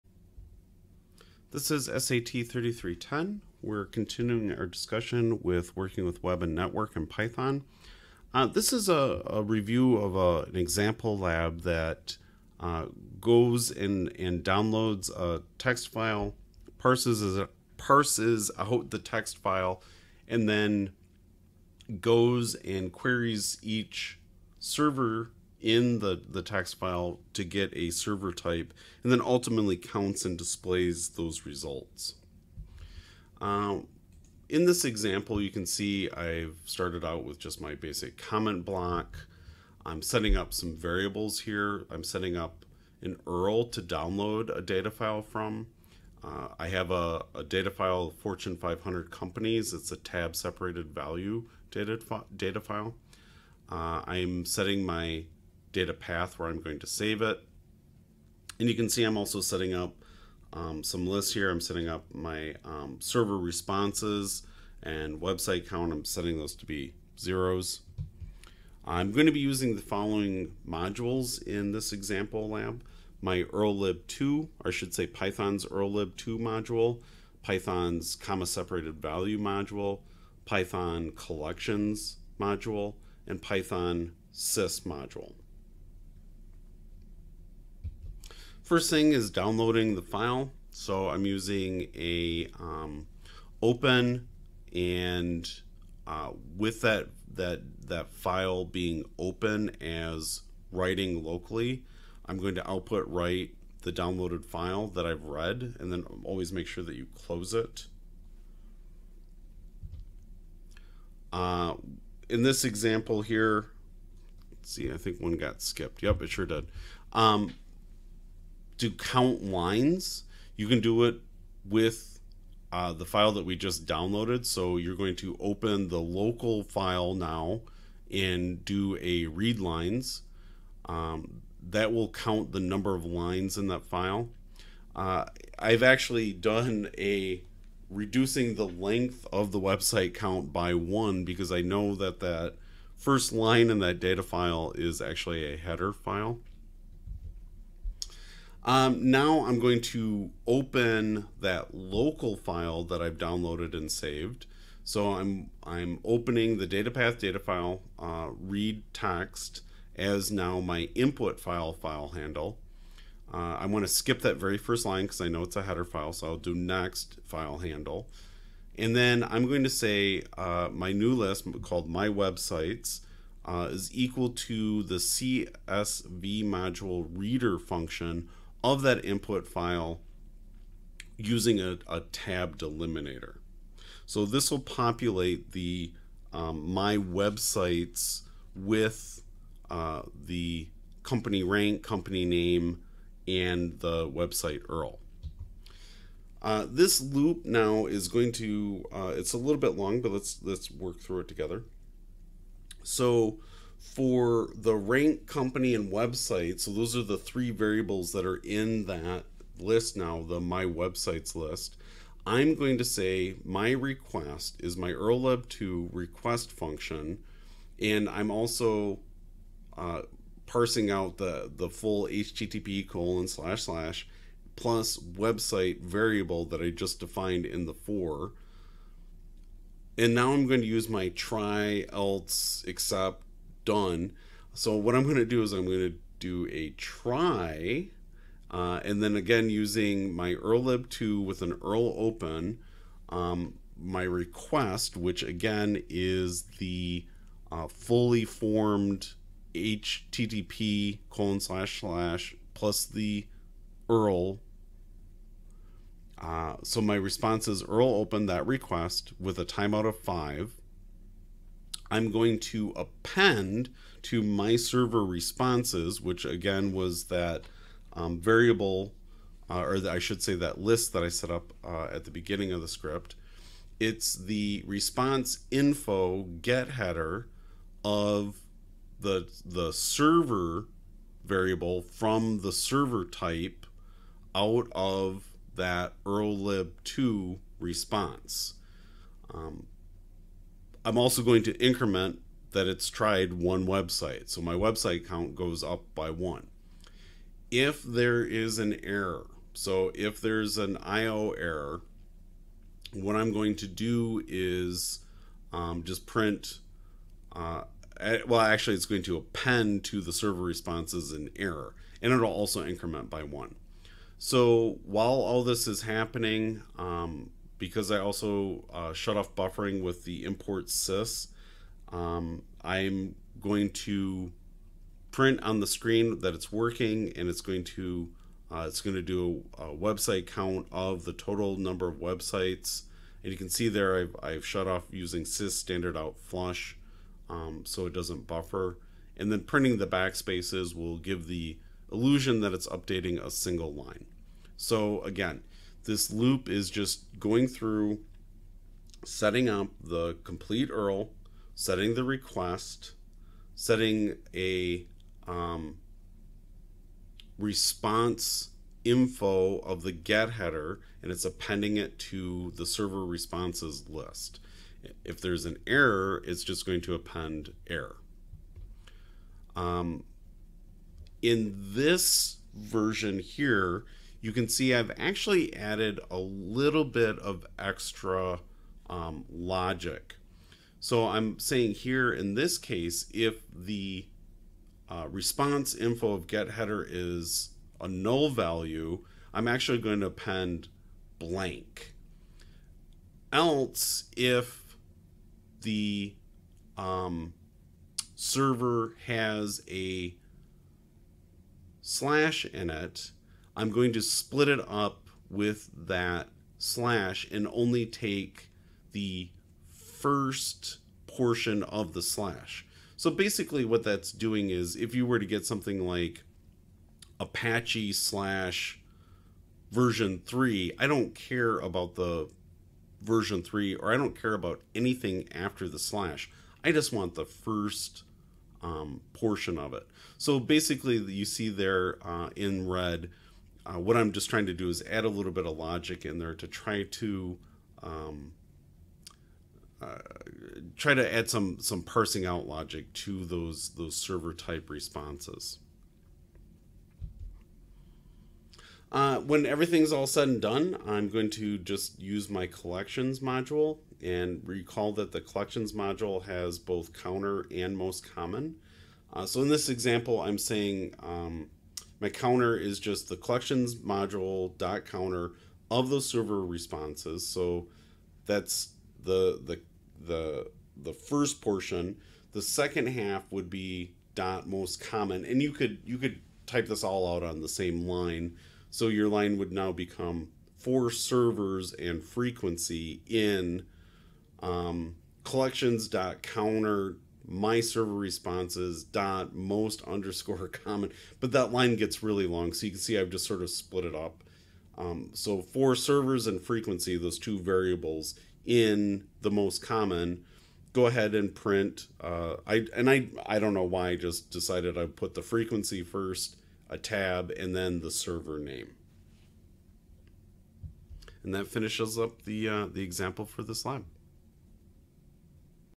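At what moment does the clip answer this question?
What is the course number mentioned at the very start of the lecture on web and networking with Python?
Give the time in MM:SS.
00:01.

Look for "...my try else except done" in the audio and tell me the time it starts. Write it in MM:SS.
03:50.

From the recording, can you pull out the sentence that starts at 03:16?
Uh, this loop now is going to, uh, it's a little bit long, but let's, let's work through it together.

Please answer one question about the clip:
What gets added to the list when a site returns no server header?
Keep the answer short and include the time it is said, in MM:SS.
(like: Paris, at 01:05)
blank, at 06:31.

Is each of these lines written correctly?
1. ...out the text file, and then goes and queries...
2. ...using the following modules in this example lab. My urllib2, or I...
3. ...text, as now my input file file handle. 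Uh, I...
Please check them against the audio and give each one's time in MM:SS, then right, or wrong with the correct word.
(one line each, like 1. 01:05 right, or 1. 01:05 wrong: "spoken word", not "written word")
1. 00:18 right
2. 01:09 right
3. 02:38 right.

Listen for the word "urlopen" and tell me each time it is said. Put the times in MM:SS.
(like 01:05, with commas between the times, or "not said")
04:01, 04:17.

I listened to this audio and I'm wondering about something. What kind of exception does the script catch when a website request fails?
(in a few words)
IO error.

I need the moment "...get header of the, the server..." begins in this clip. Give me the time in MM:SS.
04:36.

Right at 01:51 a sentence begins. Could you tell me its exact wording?
Uh, in this example here, see, I think one got skipped.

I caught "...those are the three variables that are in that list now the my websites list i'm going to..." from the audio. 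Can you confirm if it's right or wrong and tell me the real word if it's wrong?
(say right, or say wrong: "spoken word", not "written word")
right.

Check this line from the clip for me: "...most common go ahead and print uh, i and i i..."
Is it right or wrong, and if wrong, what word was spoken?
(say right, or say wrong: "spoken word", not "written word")
right.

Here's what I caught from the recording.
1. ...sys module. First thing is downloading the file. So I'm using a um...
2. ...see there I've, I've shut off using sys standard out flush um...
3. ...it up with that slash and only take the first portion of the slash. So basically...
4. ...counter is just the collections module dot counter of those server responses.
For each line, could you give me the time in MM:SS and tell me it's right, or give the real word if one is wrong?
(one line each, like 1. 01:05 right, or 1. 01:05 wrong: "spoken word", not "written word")
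1. 01:24 right
2. 05:33 right
3. 06:44 right
4. 07:42 right.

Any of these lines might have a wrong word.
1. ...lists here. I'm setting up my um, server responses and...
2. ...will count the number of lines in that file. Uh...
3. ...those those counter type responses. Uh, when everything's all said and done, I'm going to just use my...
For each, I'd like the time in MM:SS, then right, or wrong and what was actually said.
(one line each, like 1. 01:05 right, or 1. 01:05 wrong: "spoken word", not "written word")
1. 01:01 right
2. 02:11 right
3. 07:23 wrong: "server", not "counter".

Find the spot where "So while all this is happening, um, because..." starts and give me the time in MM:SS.
05:14.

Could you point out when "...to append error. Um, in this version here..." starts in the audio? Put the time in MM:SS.
06:06.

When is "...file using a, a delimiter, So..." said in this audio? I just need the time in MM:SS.
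02:59.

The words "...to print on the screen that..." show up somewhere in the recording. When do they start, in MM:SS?
05:23.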